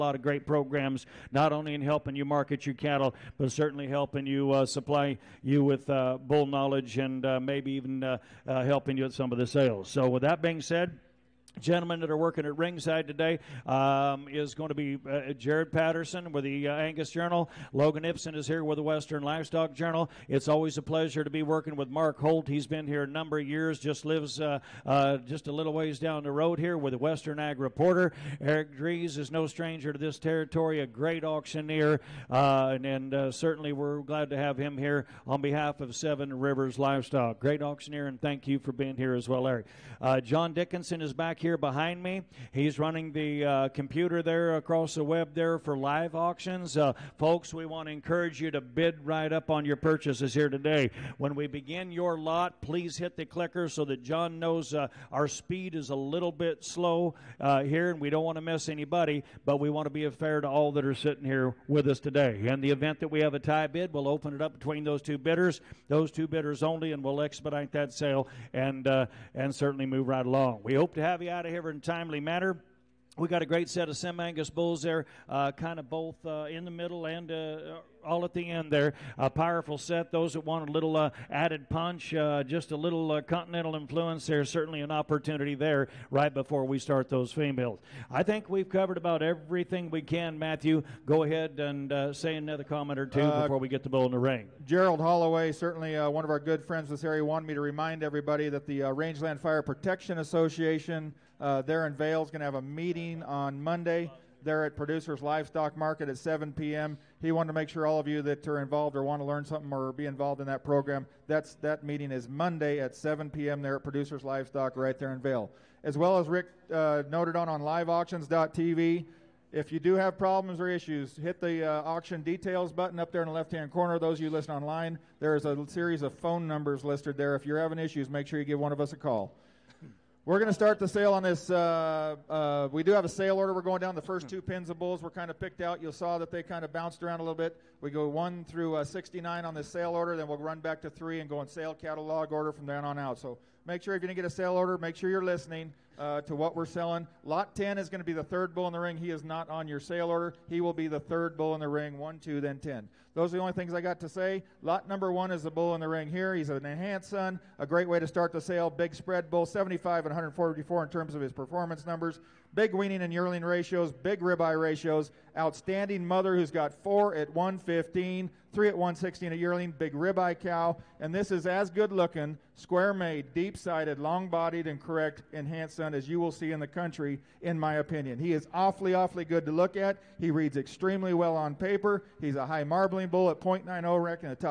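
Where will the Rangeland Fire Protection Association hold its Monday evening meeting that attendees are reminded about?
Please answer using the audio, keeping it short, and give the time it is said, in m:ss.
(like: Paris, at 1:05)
Producers Livestock Market, at 1:44.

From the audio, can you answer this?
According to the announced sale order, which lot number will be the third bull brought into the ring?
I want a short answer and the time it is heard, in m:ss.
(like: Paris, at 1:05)
10, at 2:27.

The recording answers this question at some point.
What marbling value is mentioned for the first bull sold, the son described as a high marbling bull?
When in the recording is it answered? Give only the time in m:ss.
3:03.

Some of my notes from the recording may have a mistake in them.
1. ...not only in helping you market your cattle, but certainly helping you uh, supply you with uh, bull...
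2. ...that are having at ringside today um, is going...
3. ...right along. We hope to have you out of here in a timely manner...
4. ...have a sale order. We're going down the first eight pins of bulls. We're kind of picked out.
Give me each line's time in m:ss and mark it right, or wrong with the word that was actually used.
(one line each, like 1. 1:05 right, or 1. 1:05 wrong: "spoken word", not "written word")
1. 0:01 right
2. 0:11 wrong: "working", not "having"
3. 1:10 right
4. 2:12 wrong: "two", not "eight".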